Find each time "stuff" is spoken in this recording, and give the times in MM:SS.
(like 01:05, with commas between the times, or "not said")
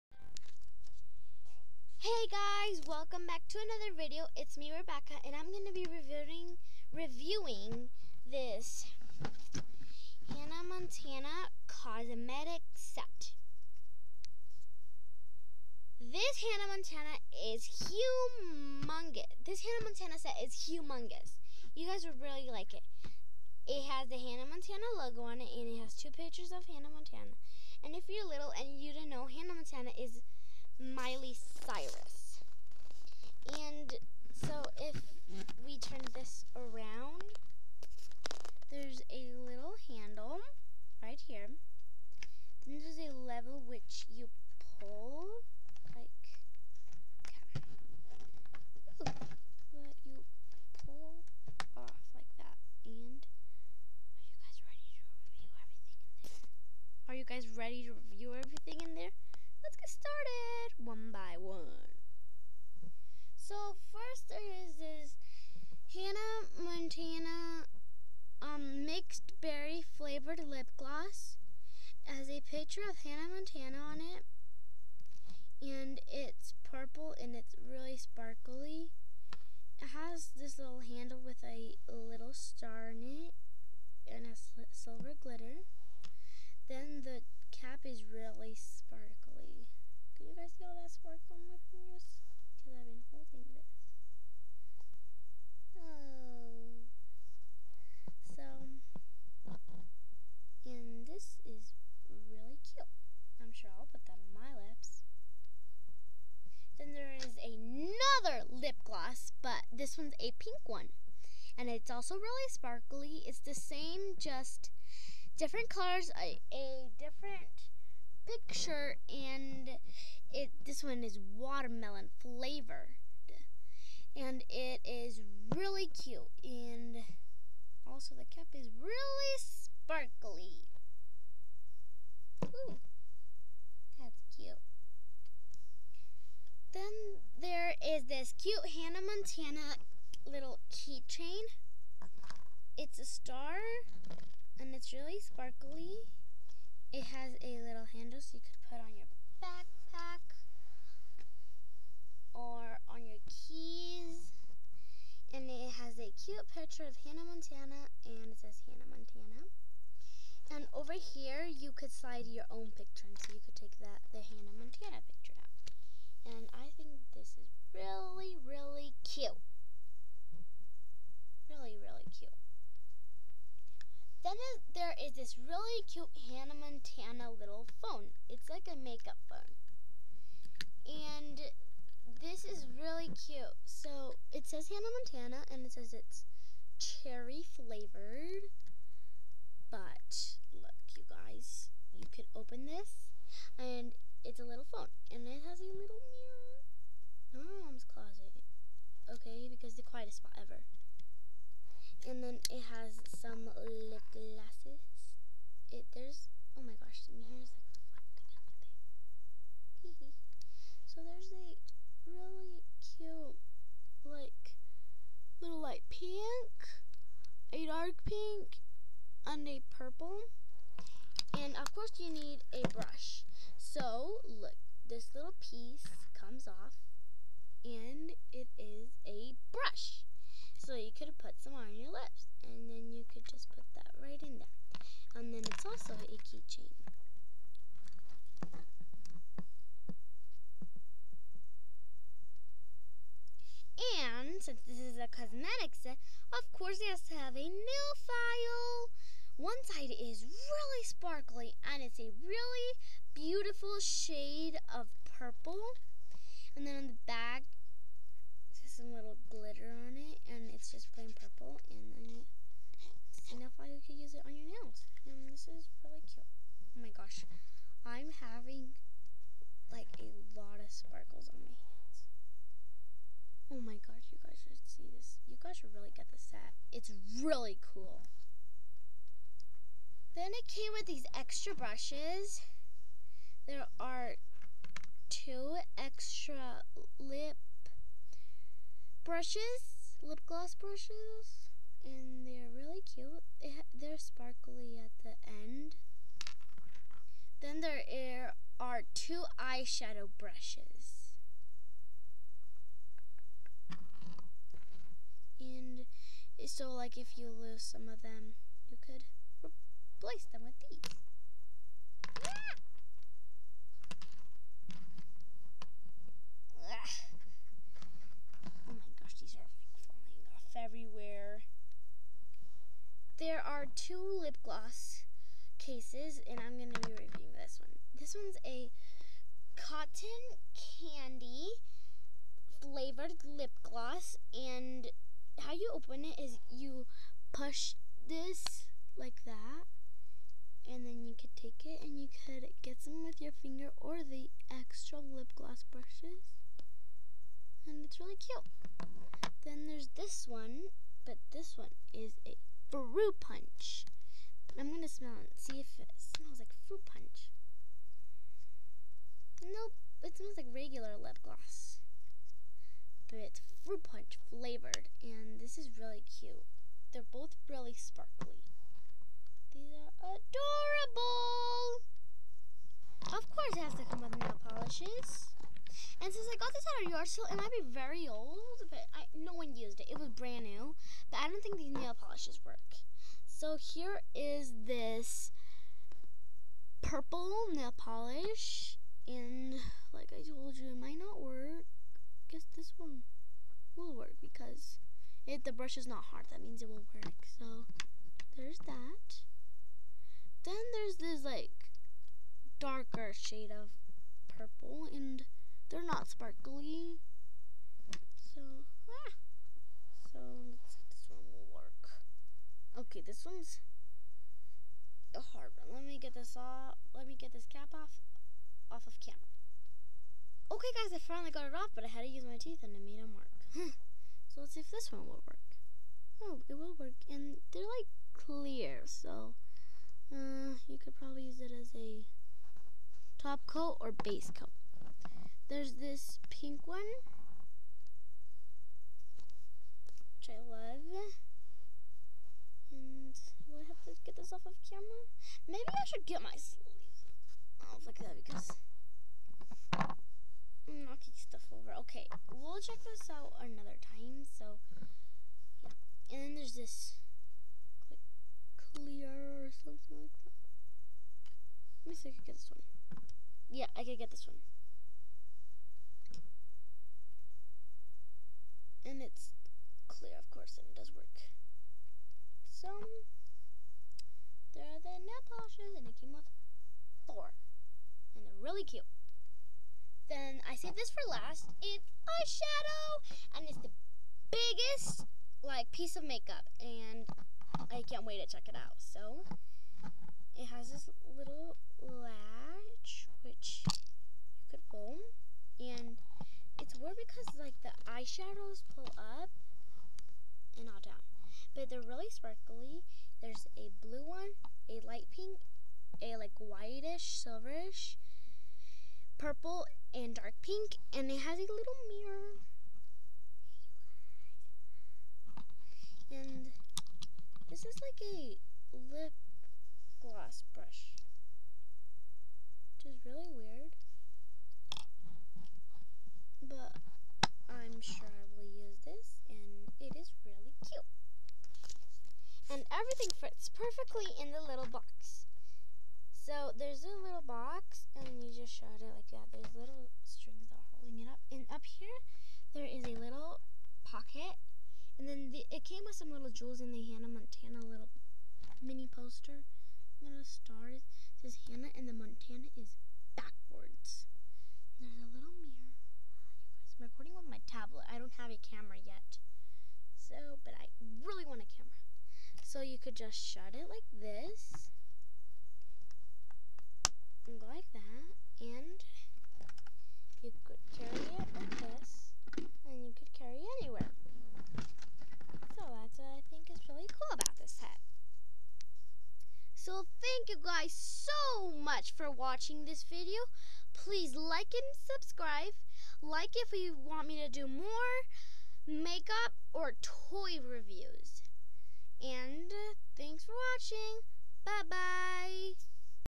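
07:31.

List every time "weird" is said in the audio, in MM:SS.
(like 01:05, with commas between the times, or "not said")
08:16, 08:43.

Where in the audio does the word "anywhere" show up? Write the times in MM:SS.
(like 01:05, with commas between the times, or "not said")
09:33.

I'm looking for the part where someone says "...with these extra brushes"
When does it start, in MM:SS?
04:40.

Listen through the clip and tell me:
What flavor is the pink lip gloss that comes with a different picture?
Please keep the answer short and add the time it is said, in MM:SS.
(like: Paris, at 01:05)
watermelon, at 02:01.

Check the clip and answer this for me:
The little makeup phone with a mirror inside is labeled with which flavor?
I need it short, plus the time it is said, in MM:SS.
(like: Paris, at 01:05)
cherry, at 03:06.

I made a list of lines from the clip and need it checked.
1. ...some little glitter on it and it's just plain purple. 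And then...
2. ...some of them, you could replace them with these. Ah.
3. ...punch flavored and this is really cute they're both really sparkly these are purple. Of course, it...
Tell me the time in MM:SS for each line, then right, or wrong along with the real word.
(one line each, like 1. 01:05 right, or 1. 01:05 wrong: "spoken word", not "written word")
1. 04:18 right
2. 05:07 right
3. 06:03 wrong: "adorable", not "purple".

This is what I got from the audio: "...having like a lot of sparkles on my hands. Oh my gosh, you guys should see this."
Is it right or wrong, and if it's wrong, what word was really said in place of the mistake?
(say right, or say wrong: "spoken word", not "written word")
right.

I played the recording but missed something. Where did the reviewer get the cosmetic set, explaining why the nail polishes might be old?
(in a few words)
yard sale.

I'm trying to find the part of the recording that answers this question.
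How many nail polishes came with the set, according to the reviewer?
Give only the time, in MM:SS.
07:57.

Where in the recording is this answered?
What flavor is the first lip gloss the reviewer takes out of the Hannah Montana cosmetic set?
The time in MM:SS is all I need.
01:08.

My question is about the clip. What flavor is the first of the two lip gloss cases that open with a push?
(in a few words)
cotton candy.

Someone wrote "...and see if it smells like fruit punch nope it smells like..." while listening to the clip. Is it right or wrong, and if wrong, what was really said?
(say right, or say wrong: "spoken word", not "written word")
right.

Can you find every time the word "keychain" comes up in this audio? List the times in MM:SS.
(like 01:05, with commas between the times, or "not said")
02:20, 03:56.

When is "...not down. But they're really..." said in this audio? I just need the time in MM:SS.
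08:20.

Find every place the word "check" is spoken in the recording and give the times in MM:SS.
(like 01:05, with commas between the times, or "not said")
07:32, 08:08.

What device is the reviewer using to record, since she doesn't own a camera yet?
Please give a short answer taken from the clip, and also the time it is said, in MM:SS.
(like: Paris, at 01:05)
tablet, at 09:17.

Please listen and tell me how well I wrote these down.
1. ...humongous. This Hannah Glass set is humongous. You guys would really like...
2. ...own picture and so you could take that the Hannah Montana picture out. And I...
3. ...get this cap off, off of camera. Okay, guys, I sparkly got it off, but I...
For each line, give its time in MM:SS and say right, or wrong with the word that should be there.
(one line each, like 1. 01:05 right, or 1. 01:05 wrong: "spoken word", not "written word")
1. 00:17 wrong: "Montana", not "Glass"
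2. 02:42 right
3. 06:57 wrong: "finally", not "sparkly".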